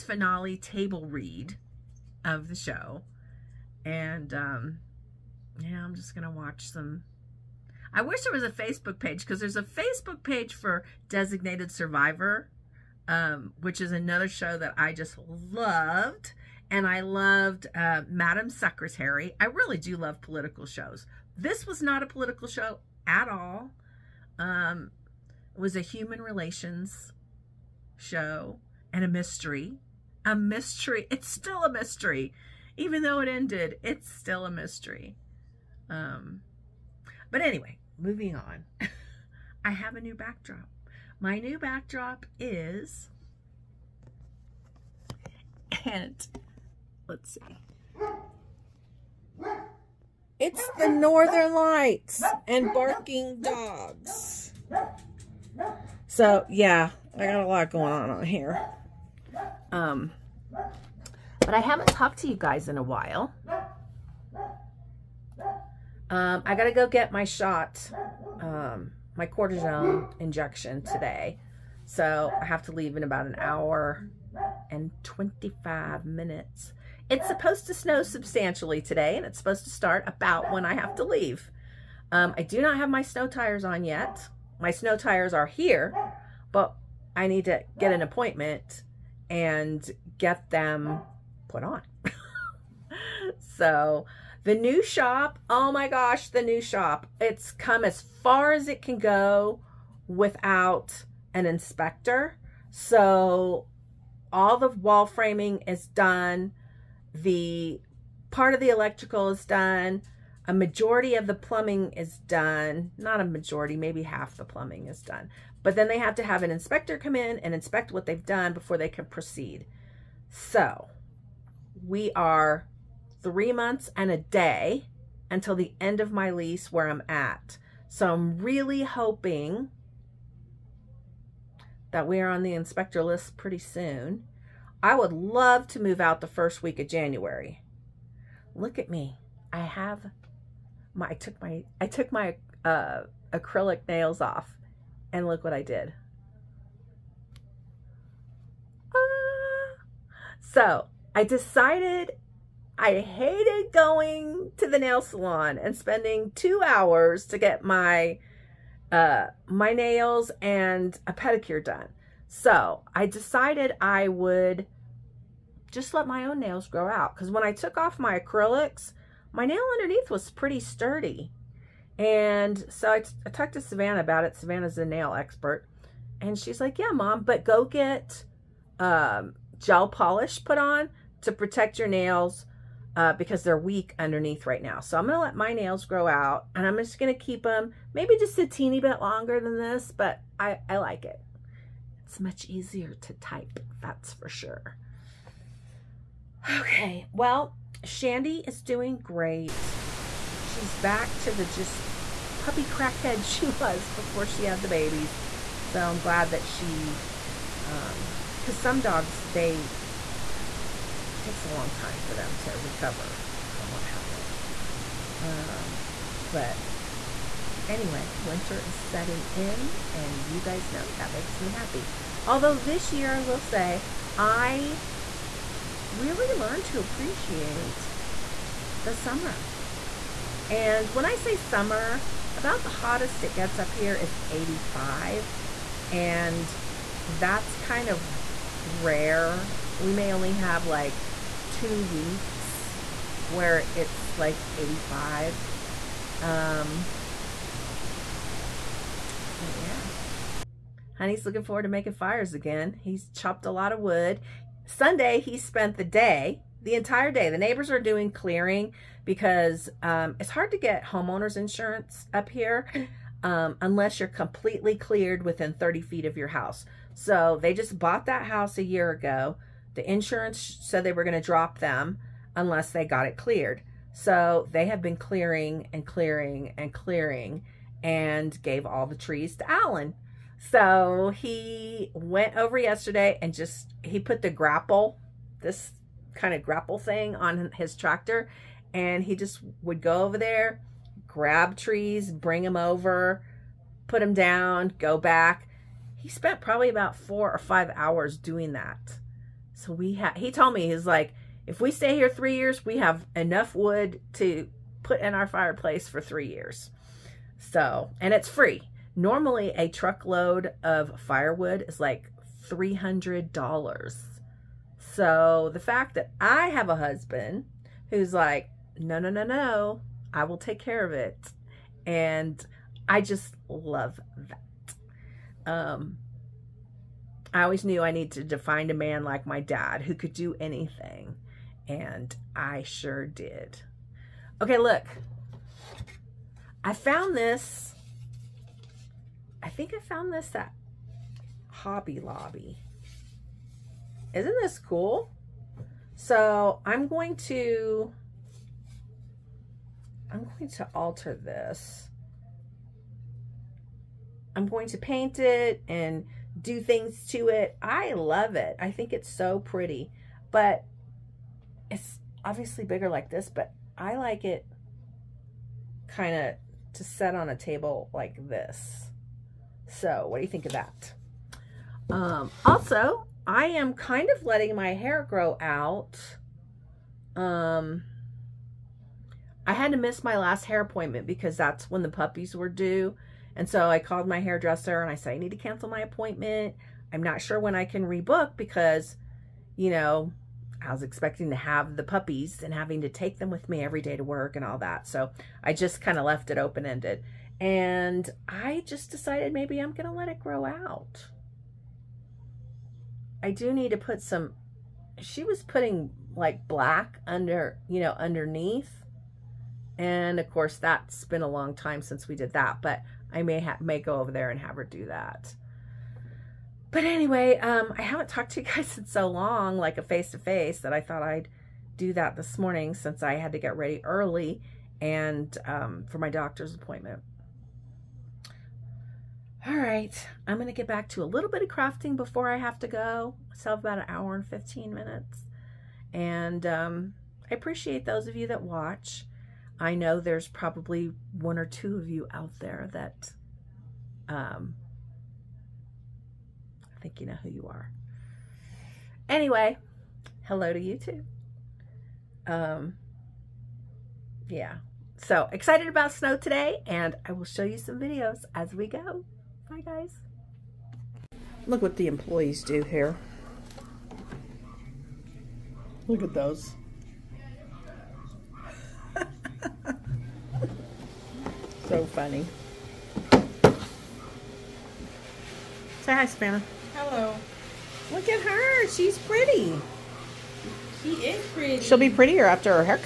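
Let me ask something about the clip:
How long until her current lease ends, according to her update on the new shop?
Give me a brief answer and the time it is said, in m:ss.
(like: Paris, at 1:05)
3 months and a day, at 2:03.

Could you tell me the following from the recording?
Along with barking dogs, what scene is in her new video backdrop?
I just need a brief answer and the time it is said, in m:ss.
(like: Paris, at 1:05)
Northern Lights, at 0:50.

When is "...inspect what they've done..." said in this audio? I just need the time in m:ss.
1:57.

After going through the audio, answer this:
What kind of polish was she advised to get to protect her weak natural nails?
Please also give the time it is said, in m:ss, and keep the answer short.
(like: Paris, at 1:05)
gel polish, at 2:59.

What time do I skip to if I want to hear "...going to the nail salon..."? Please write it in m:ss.
2:33.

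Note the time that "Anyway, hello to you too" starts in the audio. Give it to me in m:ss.
7:29.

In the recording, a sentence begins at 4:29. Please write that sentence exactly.
The insurance said they were going to drop them unless they got it cleared.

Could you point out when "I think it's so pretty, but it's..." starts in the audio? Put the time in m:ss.
5:58.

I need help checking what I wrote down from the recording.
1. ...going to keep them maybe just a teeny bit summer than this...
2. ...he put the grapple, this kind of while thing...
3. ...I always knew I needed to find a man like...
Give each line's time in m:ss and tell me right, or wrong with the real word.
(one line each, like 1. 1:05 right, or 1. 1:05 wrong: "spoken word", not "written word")
1. 3:06 wrong: "longer", not "summer"
2. 4:43 wrong: "grapple", not "while"
3. 5:27 right.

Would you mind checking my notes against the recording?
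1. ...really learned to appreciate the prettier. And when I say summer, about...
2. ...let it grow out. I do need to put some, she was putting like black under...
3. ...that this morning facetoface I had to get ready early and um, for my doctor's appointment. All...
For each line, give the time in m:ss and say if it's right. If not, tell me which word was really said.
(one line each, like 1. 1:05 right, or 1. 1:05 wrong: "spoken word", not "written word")
1. 3:45 wrong: "summer", not "prettier"
2. 6:39 right
3. 7:01 wrong: "since", not "facetoface".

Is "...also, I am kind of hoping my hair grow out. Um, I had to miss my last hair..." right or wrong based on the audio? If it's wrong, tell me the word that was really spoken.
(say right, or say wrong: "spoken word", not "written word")
wrong: "letting", not "hoping".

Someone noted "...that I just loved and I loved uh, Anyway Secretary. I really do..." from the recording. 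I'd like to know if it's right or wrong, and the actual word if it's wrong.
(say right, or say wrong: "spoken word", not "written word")
wrong: "Madam", not "Anyway".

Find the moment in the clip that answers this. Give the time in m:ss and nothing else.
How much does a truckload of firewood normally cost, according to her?
5:12.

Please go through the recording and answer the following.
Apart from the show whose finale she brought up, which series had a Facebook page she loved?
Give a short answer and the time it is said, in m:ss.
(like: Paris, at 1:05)
Designated Survivor, at 0:11.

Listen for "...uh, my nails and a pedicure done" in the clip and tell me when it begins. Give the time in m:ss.
2:38.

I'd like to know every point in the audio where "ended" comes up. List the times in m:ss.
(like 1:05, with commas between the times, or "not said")
0:33, 6:36.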